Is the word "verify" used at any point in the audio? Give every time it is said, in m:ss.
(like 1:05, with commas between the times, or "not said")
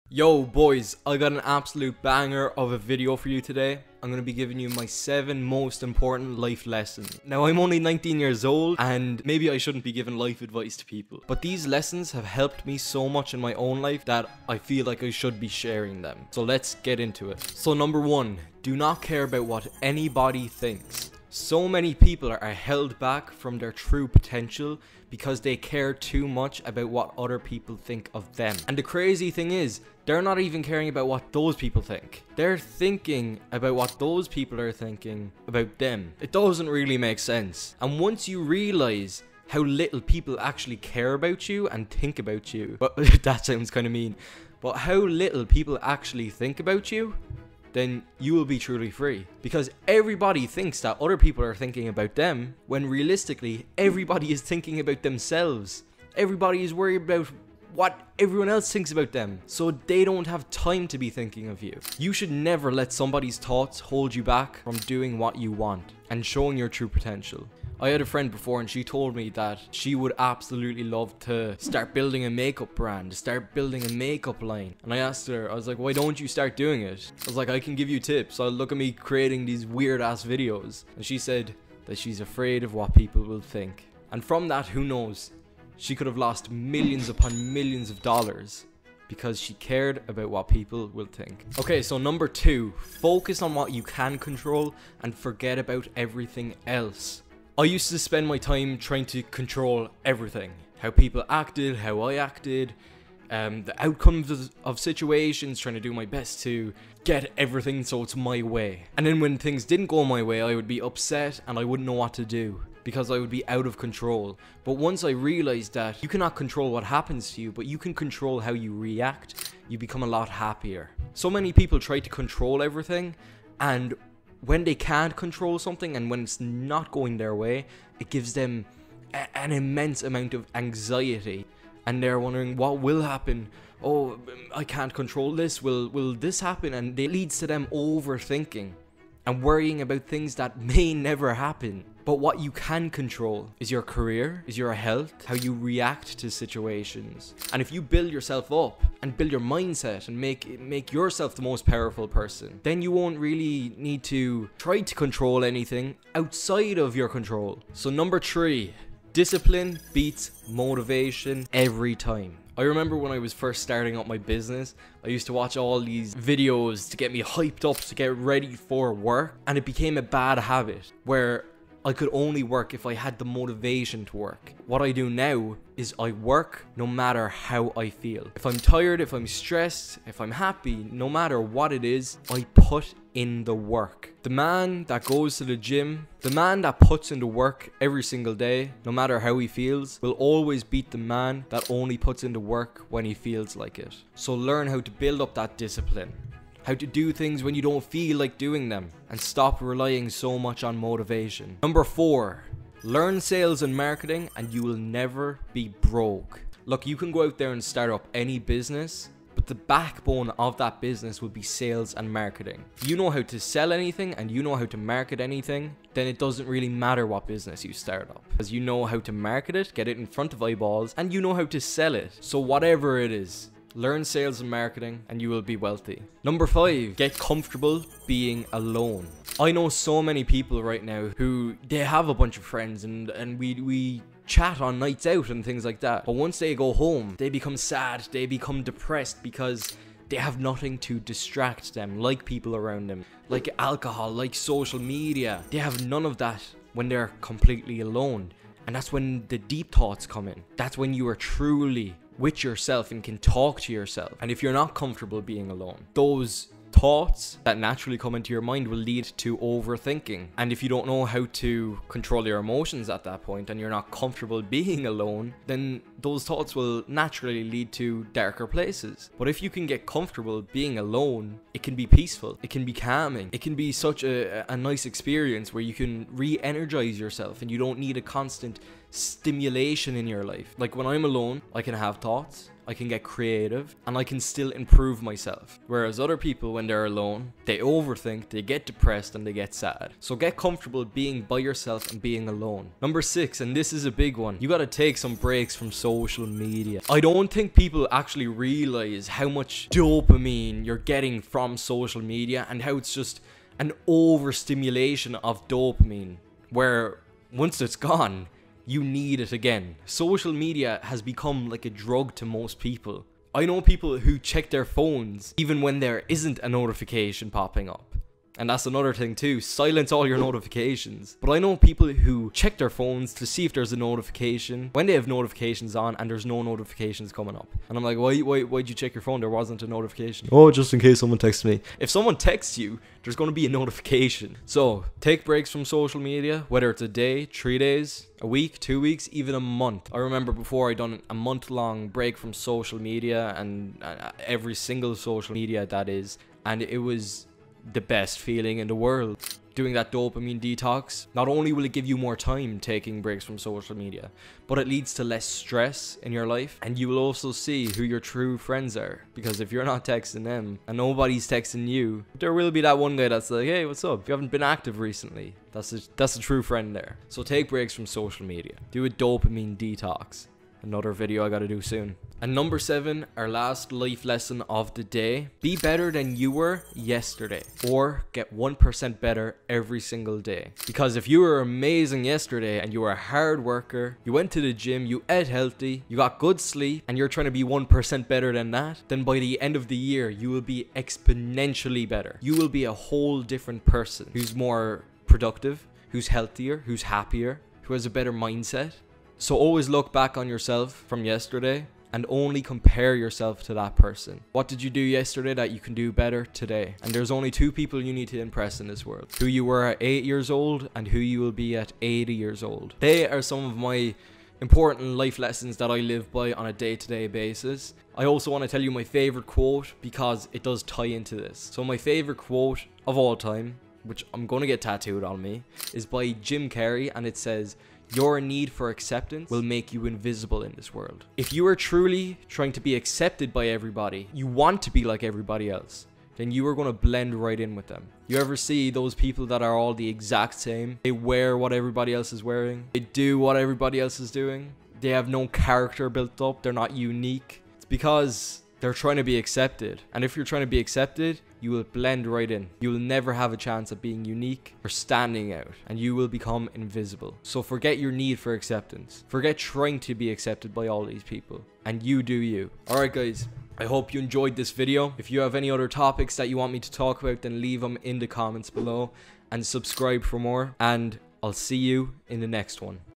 not said.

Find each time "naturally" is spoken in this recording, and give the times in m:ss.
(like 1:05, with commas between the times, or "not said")
4:17, 4:26.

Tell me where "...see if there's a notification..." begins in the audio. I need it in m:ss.
5:23.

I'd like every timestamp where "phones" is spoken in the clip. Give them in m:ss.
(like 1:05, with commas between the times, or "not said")
5:14, 5:22, 5:29.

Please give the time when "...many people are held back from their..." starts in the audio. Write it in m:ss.
0:21.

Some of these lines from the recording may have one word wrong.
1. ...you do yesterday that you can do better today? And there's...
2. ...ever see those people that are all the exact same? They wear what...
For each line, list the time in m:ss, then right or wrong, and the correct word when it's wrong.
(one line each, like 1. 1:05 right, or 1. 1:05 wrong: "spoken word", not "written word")
1. 6:44 right
2. 7:18 right.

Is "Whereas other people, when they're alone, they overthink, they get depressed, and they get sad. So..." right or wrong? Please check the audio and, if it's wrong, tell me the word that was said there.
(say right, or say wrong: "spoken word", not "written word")
right.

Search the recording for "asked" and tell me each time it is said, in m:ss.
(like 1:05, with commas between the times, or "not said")
1:14.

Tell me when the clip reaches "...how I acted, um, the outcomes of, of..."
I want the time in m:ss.
1:41.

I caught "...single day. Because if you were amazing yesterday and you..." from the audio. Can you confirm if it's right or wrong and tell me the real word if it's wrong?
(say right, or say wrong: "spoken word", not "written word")
right.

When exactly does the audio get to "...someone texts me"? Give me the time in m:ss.
5:30.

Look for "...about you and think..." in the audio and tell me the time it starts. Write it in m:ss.
0:41.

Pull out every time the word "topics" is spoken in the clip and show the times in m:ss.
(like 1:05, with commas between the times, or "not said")
7:45.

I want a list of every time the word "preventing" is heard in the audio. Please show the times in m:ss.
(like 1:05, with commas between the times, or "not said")
not said.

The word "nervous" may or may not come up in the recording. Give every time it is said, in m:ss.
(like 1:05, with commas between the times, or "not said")
not said.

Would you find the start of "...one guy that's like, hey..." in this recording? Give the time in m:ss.
6:02.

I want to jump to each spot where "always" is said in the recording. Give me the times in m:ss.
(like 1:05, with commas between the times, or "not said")
3:10, 6:39.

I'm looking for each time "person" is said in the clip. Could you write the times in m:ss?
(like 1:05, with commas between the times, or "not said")
2:32, 6:33, 6:43.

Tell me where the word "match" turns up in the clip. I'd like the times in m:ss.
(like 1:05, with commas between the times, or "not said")
not said.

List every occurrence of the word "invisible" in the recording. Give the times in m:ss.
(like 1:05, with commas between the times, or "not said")
7:09, 7:36.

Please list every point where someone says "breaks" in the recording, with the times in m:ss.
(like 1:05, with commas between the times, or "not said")
4:55, 5:35, 5:41, 5:53, 6:07.